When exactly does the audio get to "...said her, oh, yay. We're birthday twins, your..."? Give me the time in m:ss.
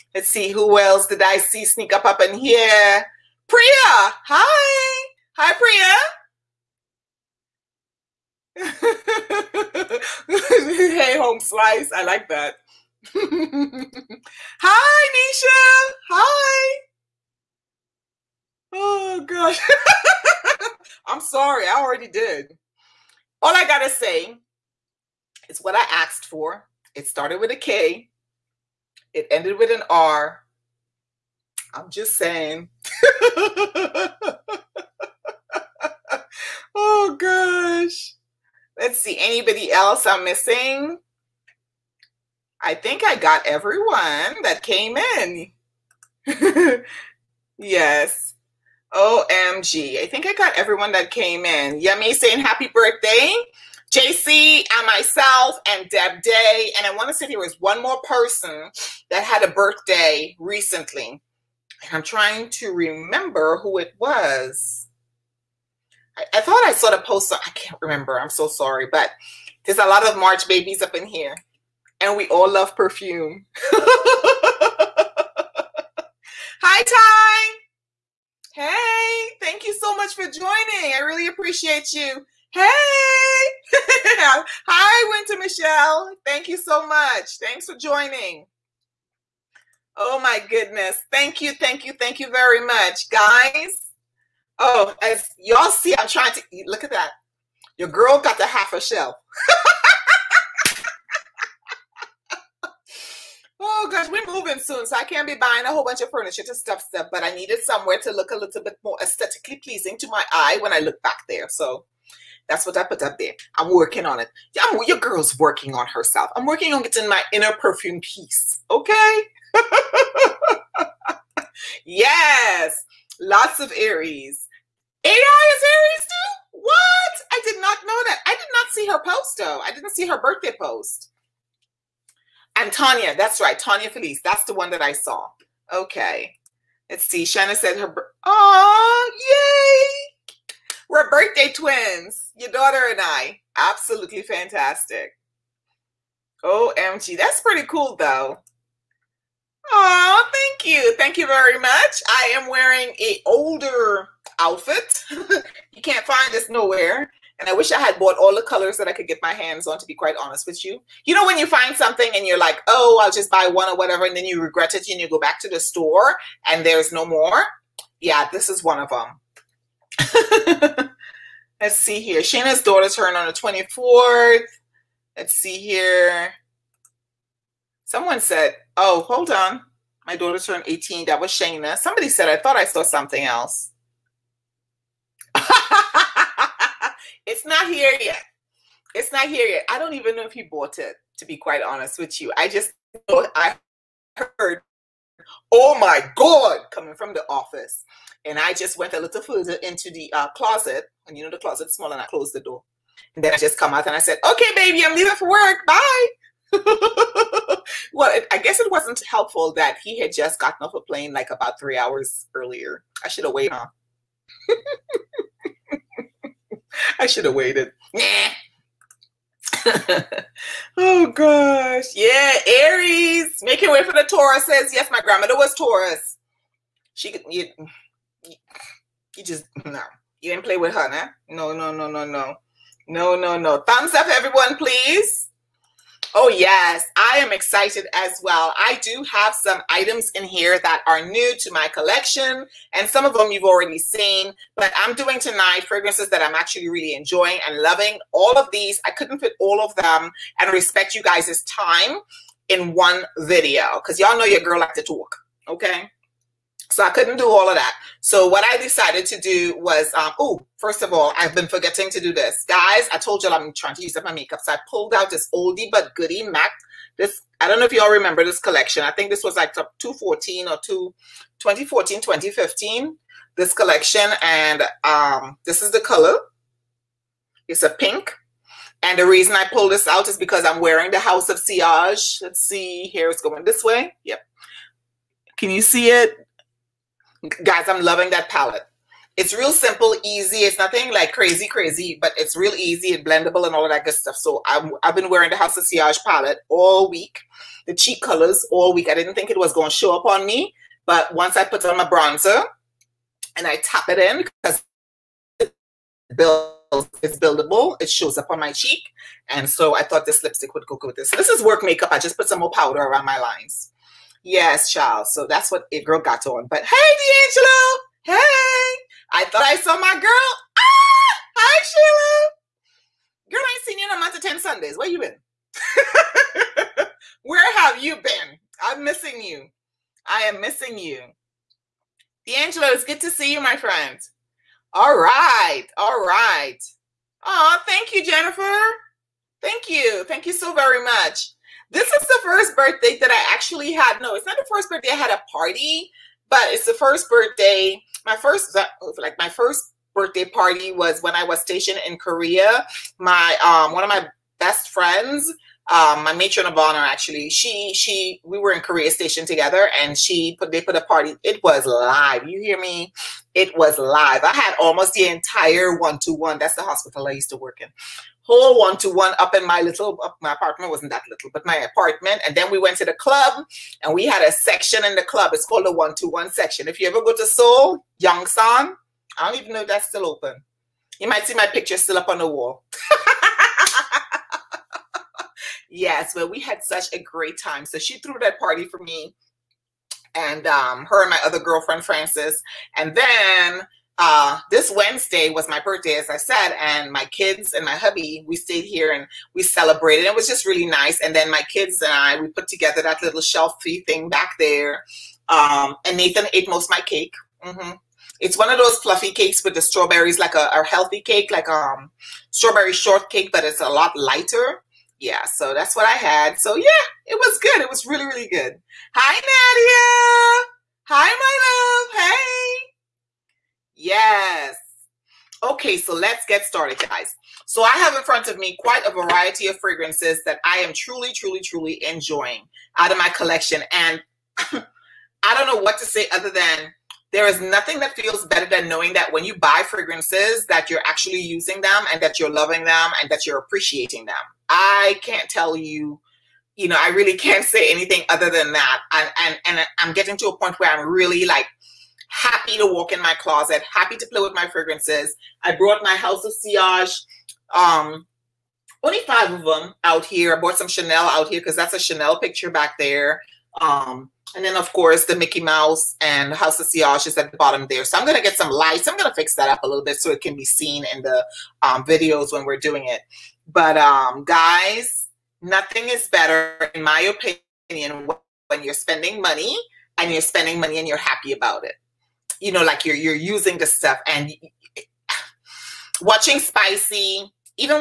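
2:17.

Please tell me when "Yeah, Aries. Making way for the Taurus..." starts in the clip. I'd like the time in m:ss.
3:41.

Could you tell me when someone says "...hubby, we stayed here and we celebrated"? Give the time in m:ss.
6:37.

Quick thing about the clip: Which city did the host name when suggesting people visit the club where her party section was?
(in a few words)
Seoul.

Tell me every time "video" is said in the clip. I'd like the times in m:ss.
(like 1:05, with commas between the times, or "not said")
4:13, 7:51.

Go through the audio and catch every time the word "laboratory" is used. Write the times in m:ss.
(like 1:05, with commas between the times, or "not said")
not said.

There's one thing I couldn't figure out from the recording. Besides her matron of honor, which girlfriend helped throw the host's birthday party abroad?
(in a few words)
Frances.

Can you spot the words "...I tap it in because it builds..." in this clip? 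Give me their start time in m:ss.
5:03.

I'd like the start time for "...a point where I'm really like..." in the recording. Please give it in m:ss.
7:30.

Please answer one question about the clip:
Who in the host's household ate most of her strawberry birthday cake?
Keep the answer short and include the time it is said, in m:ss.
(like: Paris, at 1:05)
Nathan, at 6:45.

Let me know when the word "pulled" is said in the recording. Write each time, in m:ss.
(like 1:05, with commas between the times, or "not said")
4:24, 4:39.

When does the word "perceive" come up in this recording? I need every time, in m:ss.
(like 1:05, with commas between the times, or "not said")
not said.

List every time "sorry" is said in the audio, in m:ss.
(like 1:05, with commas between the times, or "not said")
0:21, 1:08.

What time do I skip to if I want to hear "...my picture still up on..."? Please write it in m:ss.
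6:21.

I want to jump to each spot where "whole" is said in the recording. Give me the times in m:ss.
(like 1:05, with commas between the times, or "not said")
1:45, 6:08.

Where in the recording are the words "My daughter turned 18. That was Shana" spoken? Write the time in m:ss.
3:00.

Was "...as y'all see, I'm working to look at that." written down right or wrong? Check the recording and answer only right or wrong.
wrong.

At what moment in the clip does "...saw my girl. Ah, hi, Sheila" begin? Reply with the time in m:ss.
5:19.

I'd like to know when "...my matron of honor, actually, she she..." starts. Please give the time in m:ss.
5:56.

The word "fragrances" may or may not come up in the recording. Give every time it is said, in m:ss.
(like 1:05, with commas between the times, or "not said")
4:05, 7:09, 7:19, 7:34.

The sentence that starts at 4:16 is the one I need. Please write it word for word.
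So I couldn't do all of that.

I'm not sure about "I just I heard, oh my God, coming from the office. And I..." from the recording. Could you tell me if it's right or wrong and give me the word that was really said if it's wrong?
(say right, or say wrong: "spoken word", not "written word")
right.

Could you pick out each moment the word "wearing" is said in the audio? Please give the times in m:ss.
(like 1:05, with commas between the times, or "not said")
2:32, 4:40, 4:55.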